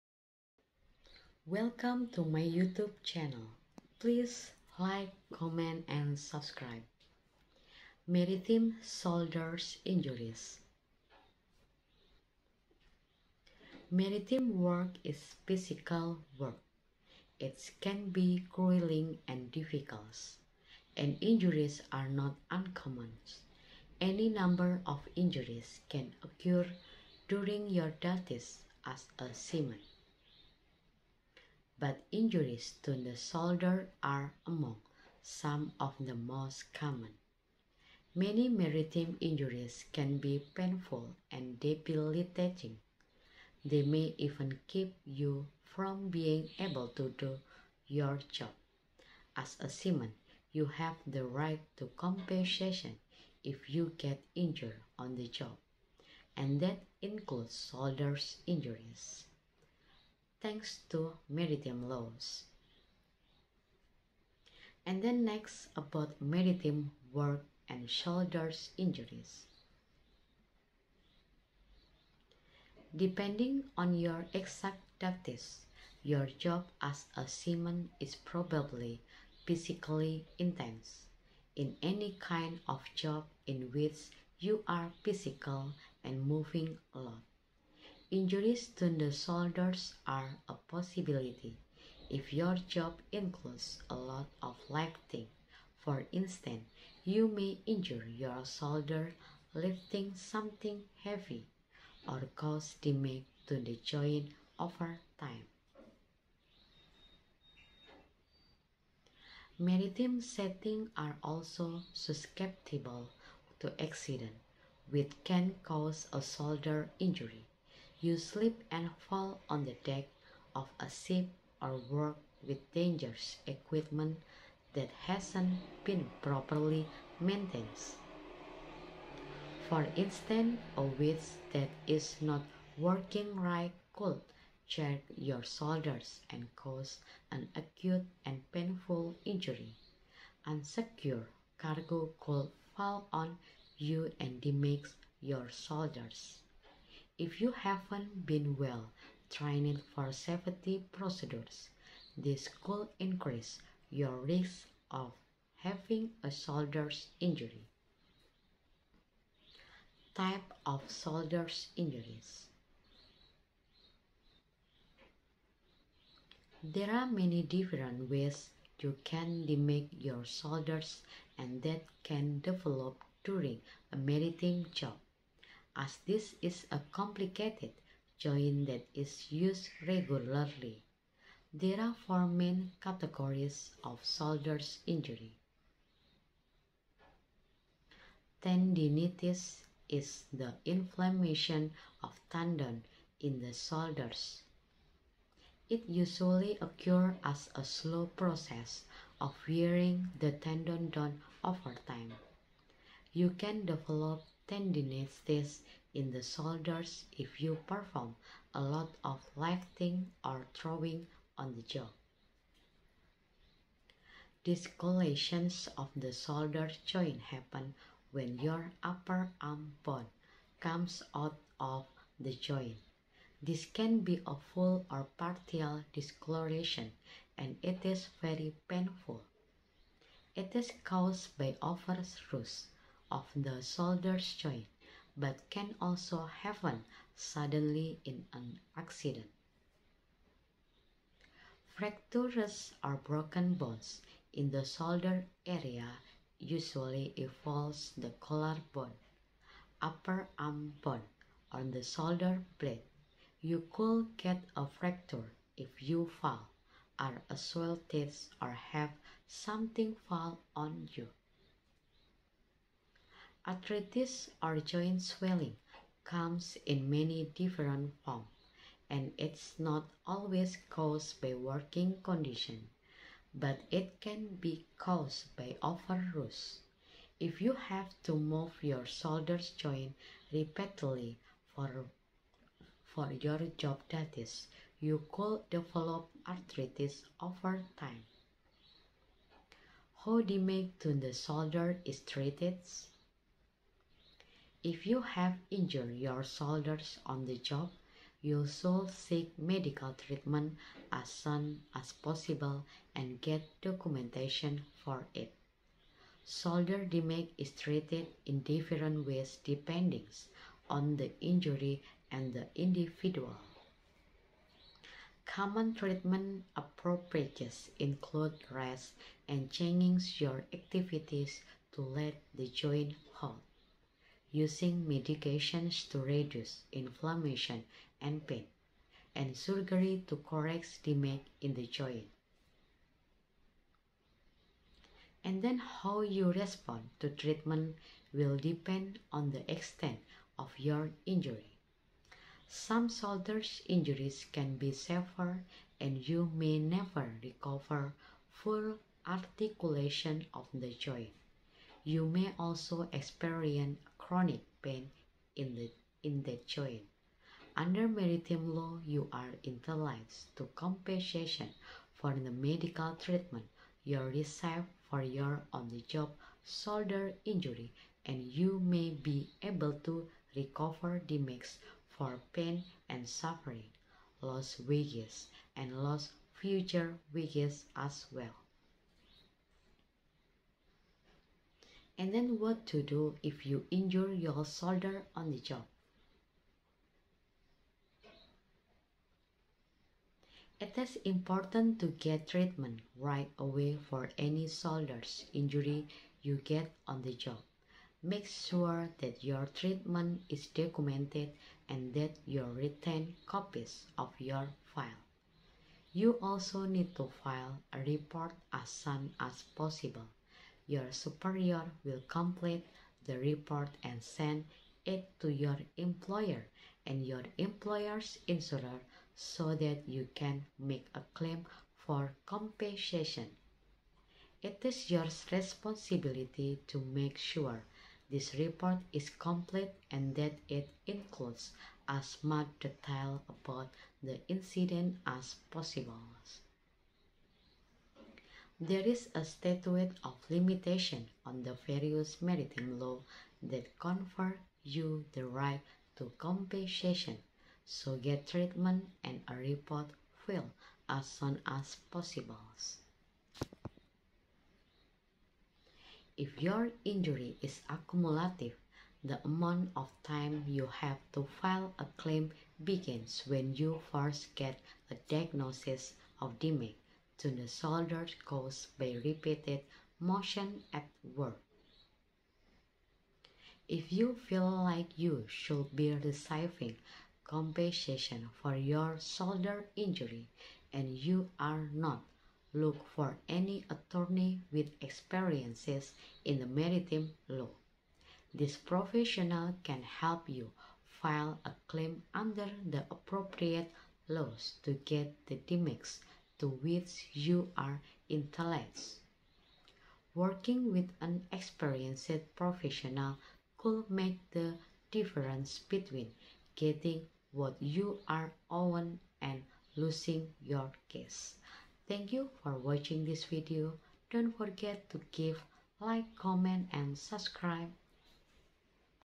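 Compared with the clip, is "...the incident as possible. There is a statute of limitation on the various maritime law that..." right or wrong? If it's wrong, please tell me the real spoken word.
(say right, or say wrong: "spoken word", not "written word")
right.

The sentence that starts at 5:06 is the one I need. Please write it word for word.
Shoulder damage is treated in different ways depending on the injury and the individual.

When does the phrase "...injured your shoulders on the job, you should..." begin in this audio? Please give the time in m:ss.
4:55.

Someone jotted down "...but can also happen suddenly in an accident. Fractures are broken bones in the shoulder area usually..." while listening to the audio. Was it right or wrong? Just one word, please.
right.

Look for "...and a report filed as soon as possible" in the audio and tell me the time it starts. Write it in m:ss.
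7:29.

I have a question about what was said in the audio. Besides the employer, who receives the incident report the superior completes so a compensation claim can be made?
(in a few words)
employer's insurer.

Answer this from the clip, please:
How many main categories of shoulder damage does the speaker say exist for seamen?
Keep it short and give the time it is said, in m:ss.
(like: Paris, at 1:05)
4, at 3:02.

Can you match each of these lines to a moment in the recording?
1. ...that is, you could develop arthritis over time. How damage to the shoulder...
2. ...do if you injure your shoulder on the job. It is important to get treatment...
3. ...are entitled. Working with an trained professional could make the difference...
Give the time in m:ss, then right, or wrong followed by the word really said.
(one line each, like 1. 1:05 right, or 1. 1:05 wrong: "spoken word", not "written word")
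1. 4:43 right
2. 6:22 right
3. 8:17 wrong: "experienced", not "trained".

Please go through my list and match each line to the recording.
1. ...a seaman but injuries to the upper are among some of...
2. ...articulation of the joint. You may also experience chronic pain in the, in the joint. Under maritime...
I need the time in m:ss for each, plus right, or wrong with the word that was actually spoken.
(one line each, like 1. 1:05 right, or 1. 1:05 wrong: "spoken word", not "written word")
1. 0:29 wrong: "shoulder", not "upper"
2. 5:49 right.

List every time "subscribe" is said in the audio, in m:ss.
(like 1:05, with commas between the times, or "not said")
0:06, 8:36.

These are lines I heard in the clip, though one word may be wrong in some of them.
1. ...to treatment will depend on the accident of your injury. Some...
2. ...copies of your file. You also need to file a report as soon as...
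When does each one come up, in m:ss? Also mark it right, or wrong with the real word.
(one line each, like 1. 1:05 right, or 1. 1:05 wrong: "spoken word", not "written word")
1. 5:37 wrong: "extent", not "accident"
2. 6:43 right.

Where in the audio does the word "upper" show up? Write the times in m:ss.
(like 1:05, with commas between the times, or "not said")
3:38, 4:09.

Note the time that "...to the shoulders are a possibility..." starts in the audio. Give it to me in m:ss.
1:28.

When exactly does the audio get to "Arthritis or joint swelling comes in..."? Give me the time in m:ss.
4:23.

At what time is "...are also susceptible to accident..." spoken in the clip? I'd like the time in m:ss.
1:50.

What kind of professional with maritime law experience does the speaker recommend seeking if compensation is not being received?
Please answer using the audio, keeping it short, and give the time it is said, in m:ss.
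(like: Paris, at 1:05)
attorney, at 8:03.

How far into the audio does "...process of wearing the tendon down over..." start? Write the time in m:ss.
3:18.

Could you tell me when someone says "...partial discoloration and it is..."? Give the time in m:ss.
3:45.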